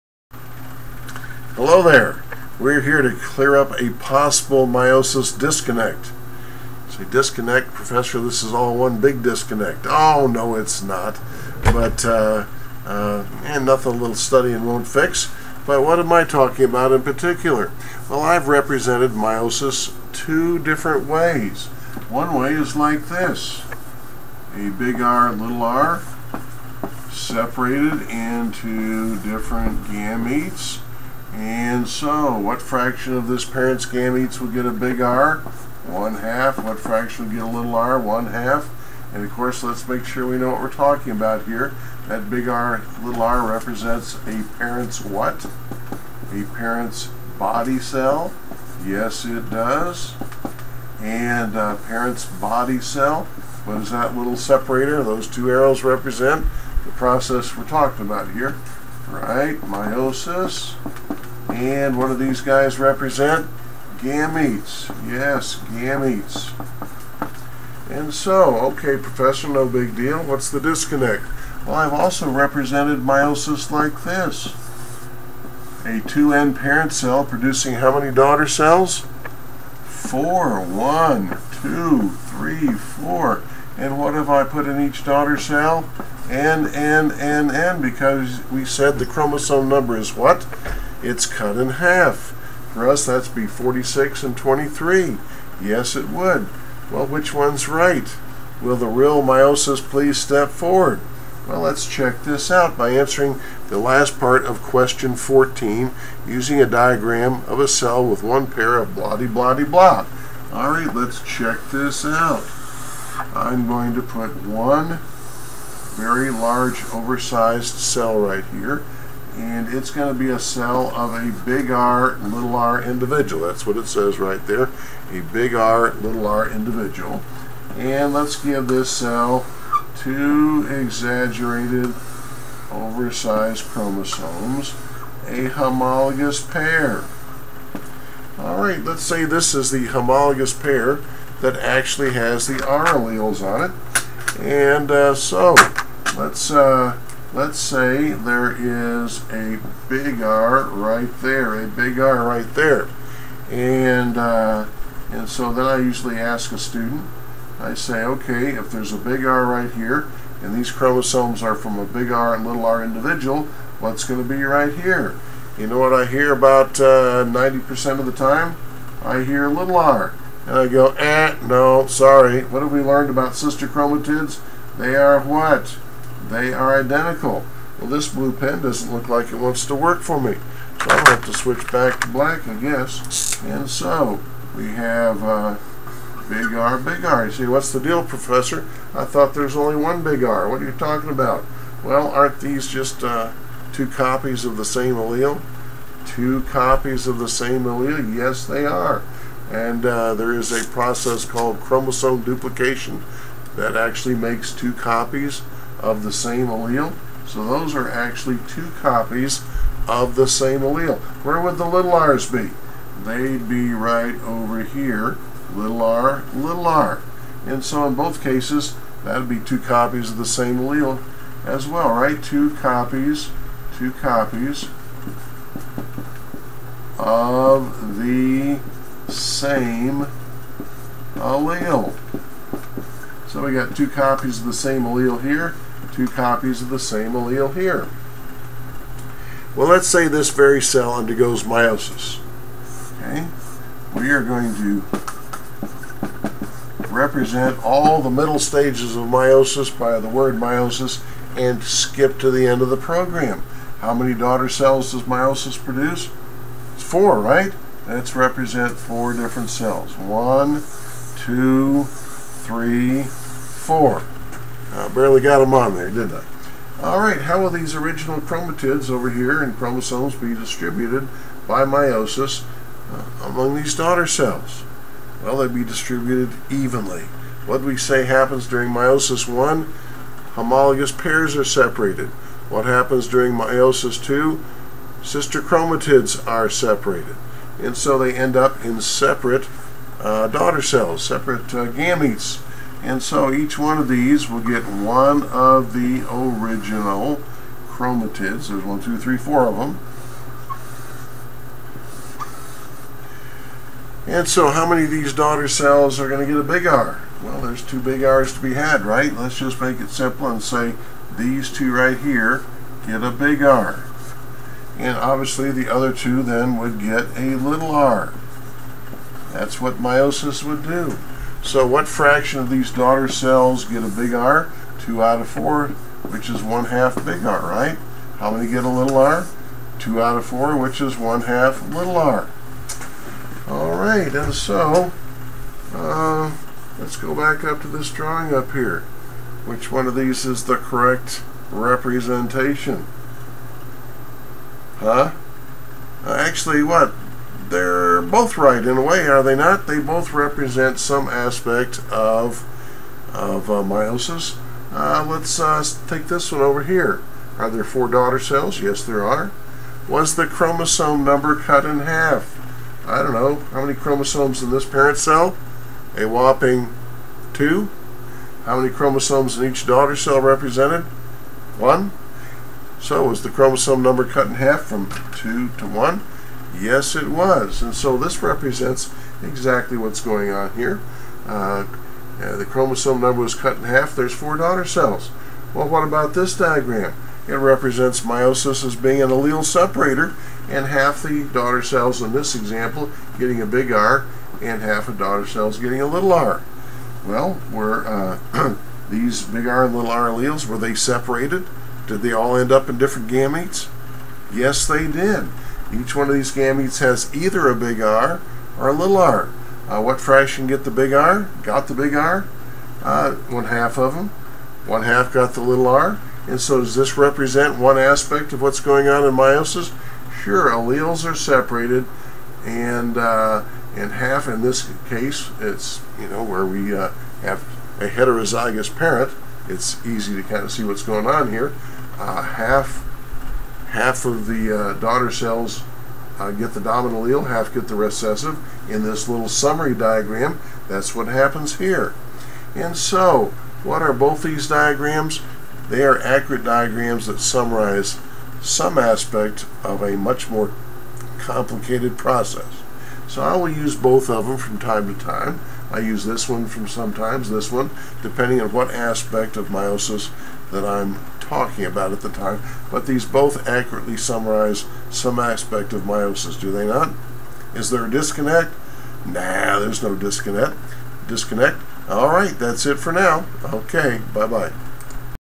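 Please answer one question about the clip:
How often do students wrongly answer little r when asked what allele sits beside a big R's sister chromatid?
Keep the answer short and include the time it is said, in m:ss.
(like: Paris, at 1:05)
90%, at 2:46.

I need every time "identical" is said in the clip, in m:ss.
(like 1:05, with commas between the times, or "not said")
2:56.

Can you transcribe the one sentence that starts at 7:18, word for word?
In this little summary diagram, that's what happens here.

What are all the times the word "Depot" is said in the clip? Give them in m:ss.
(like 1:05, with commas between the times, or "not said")
not said.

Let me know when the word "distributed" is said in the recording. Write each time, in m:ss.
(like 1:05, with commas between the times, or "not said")
4:30, 4:35.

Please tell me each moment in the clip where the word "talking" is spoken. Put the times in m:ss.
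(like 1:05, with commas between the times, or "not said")
0:16, 0:40, 0:57, 3:10, 7:41.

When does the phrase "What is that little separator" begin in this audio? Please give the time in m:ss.
0:53.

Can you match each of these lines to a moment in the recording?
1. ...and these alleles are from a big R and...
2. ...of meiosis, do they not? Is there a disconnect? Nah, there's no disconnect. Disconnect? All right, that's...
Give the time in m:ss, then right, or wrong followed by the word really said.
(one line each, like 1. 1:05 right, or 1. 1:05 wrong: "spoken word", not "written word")
1. 2:40 wrong: "chromosomes", not "alleles"
2. 7:45 right.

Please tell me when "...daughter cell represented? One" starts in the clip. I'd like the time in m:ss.
6:09.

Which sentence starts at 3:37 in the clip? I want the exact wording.
And so in both cases, that'd be two copies of the same allele as well, right?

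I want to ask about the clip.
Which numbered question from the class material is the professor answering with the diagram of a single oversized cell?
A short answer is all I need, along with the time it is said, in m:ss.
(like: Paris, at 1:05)
14, at 1:45.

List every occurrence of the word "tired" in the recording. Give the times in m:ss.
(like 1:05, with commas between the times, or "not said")
not said.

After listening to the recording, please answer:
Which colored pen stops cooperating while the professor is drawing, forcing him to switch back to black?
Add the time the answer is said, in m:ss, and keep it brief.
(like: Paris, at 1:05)
blue, at 2:58.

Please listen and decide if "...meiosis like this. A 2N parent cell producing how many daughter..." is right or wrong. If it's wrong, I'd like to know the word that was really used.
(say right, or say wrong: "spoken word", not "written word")
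right.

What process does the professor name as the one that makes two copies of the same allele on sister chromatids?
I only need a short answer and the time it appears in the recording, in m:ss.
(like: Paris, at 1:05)
chromosome duplication, at 3:21.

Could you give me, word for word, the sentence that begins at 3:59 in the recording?
Well, let's say this very cell undergoes meiosis.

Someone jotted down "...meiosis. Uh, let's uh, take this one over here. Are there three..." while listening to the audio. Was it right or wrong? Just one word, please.
wrong.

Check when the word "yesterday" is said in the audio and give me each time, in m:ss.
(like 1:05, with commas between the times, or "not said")
not said.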